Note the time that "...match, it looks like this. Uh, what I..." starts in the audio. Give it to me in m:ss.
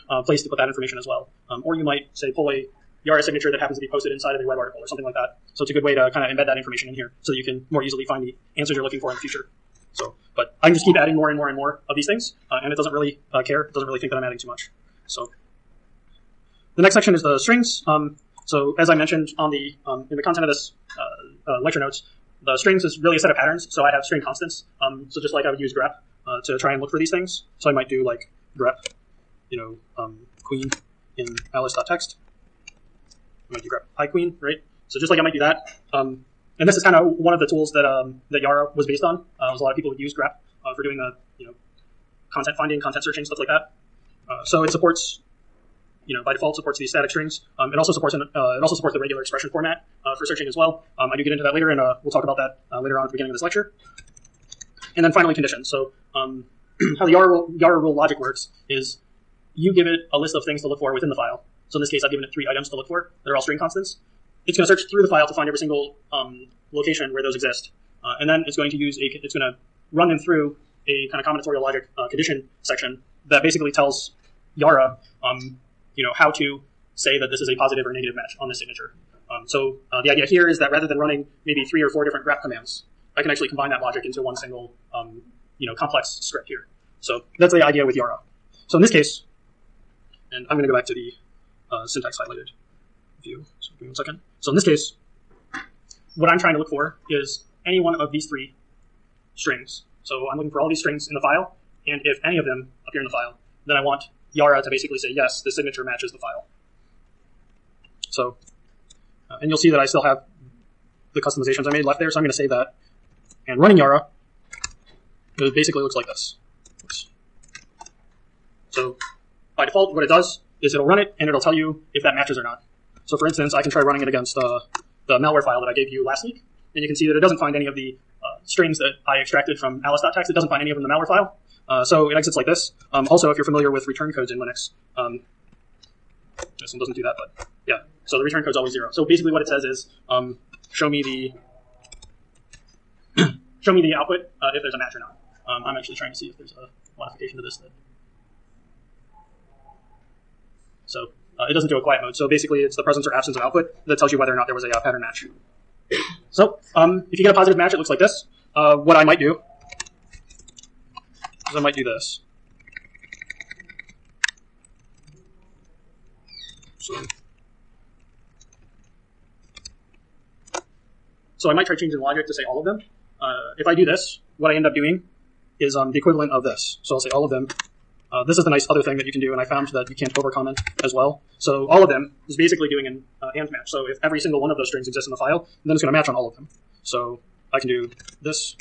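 2:37.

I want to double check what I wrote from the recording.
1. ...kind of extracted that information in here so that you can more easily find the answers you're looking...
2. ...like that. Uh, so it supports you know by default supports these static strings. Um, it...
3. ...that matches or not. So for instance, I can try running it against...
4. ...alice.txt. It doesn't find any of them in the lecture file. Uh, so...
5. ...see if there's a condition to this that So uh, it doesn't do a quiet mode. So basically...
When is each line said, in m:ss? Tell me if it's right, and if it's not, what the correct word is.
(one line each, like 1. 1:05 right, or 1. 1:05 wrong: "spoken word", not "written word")
1. 0:06 wrong: "embed", not "extracted"
2. 0:43 right
3. 2:02 right
4. 2:09 wrong: "malware", not "lecture"
5. 2:26 wrong: "modification", not "condition".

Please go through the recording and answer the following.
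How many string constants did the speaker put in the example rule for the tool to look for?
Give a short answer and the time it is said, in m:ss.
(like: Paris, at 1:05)
3, at 1:02.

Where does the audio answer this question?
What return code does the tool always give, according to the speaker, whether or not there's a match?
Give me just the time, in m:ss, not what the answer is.
2:18.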